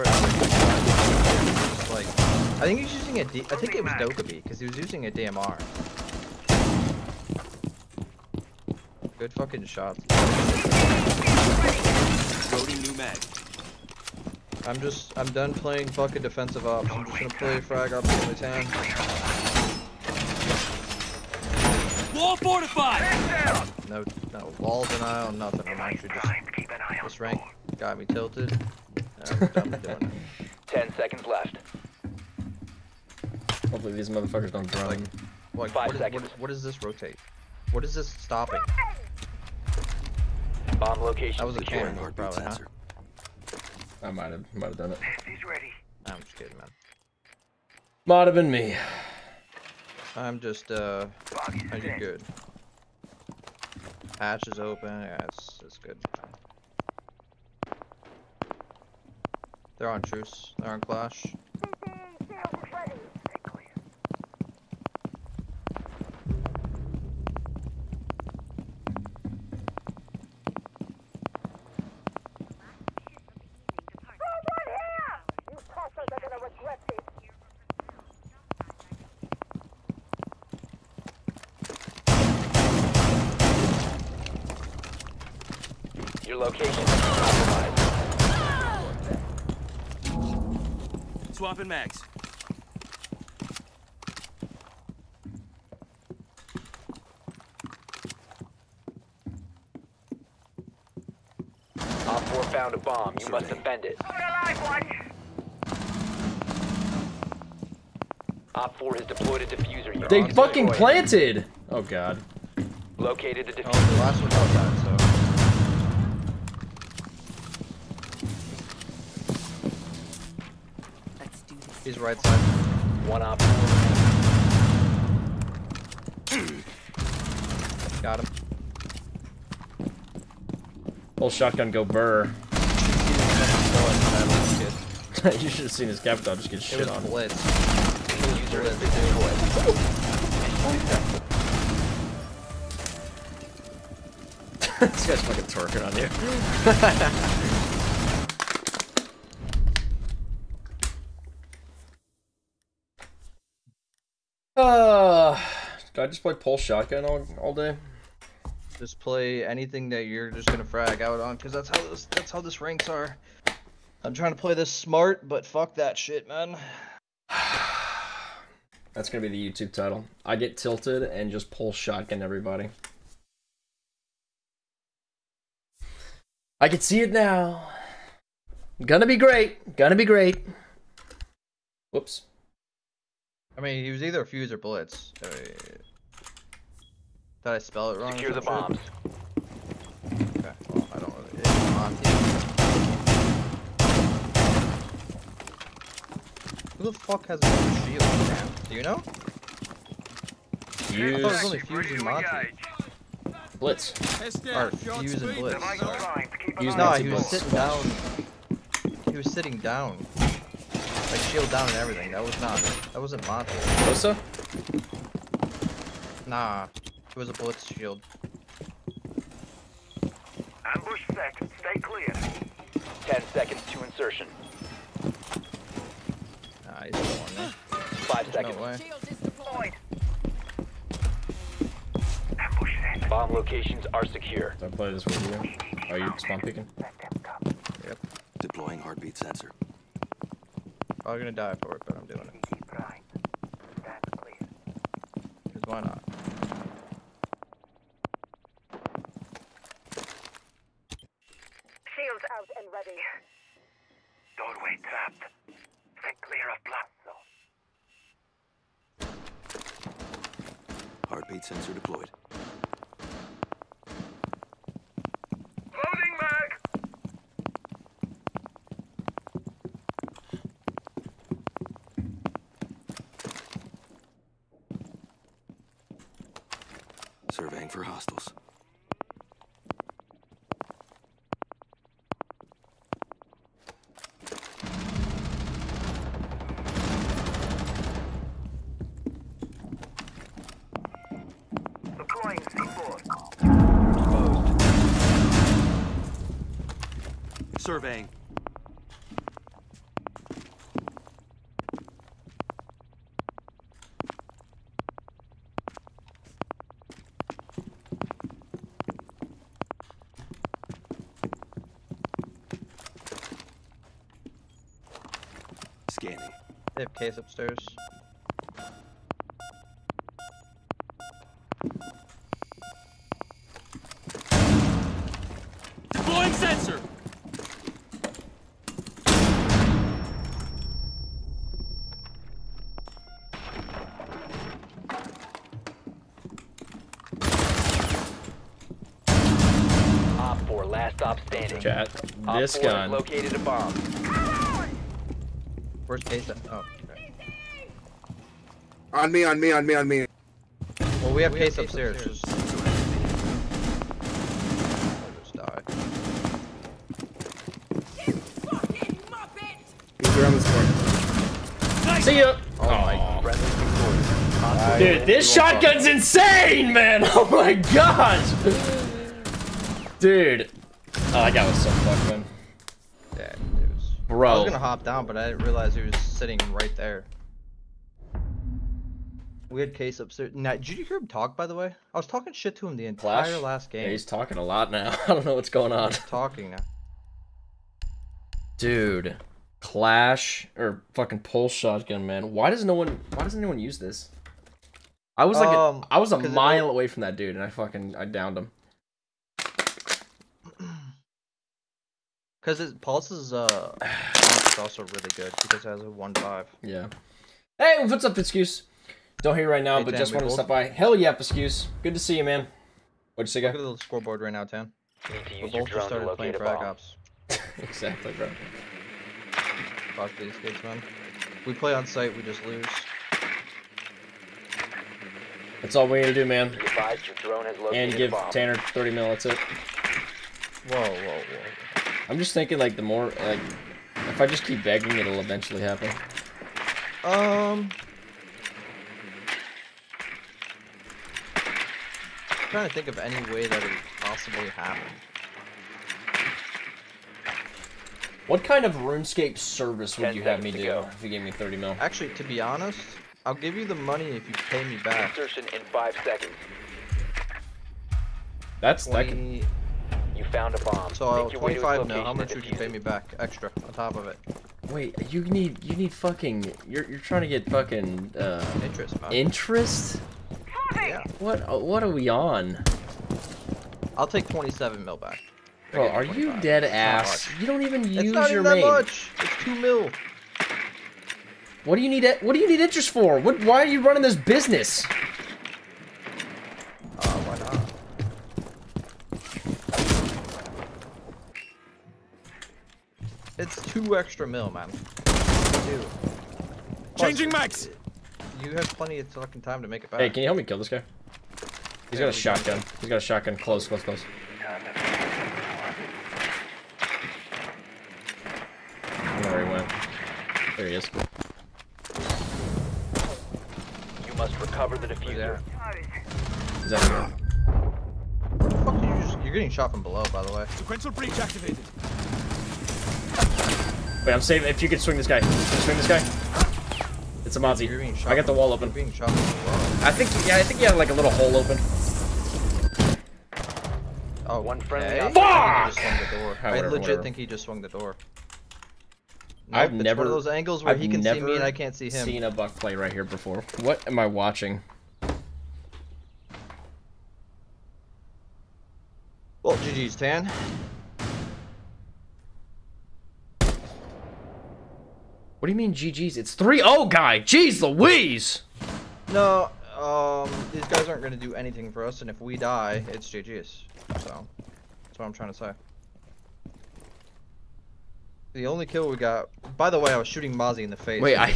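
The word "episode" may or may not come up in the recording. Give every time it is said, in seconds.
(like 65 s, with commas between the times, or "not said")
not said.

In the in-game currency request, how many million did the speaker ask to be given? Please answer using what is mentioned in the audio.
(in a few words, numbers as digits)
30 mil.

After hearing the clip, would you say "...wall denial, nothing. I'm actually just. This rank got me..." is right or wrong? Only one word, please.
right.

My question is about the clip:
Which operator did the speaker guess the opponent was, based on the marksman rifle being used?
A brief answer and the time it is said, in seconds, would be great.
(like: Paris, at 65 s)
Dokkaebi, at 3 s.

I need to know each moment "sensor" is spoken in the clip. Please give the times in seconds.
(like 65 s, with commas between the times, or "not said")
239 s.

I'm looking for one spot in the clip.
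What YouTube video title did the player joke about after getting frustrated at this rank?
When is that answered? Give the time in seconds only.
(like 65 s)
170 s.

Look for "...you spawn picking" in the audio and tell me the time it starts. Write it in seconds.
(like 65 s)
235 s.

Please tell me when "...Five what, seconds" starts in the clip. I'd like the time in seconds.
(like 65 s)
35 s.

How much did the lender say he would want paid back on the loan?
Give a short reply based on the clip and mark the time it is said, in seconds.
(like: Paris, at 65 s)
27 mil, at 473 s.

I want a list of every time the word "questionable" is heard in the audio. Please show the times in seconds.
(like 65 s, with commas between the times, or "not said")
not said.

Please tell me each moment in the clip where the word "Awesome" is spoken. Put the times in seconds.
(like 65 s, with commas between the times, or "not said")
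364 s.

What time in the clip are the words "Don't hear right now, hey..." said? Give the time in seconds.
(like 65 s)
409 s.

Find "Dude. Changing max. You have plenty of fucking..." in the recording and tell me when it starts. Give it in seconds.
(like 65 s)
495 s.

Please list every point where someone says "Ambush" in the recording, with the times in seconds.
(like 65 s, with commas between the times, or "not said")
220 s, 232 s.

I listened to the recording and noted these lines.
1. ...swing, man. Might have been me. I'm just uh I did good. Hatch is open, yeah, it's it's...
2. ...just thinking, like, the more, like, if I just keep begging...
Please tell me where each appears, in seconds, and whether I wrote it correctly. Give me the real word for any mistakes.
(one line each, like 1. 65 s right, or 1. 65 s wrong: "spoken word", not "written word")
1. 46 s wrong: "kidding", not "swing"
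2. 432 s right.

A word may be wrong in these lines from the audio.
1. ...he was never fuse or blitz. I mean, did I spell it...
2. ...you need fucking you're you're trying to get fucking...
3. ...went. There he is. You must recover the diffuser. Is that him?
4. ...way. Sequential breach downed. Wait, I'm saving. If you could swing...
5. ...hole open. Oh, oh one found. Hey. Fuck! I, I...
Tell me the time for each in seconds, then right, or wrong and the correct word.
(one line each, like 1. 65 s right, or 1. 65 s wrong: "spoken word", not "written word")
1. 183 s wrong: "either", not "never"
2. 465 s right
3. 509 s right
4. 520 s wrong: "activated", not "downed"
5. 531 s wrong: "friend", not "found".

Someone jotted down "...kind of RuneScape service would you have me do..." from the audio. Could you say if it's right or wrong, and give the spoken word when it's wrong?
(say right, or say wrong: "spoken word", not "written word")
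right.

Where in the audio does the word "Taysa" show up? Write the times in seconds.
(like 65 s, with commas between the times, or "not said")
346 s.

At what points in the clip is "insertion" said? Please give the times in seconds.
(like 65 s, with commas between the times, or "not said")
223 s, 455 s.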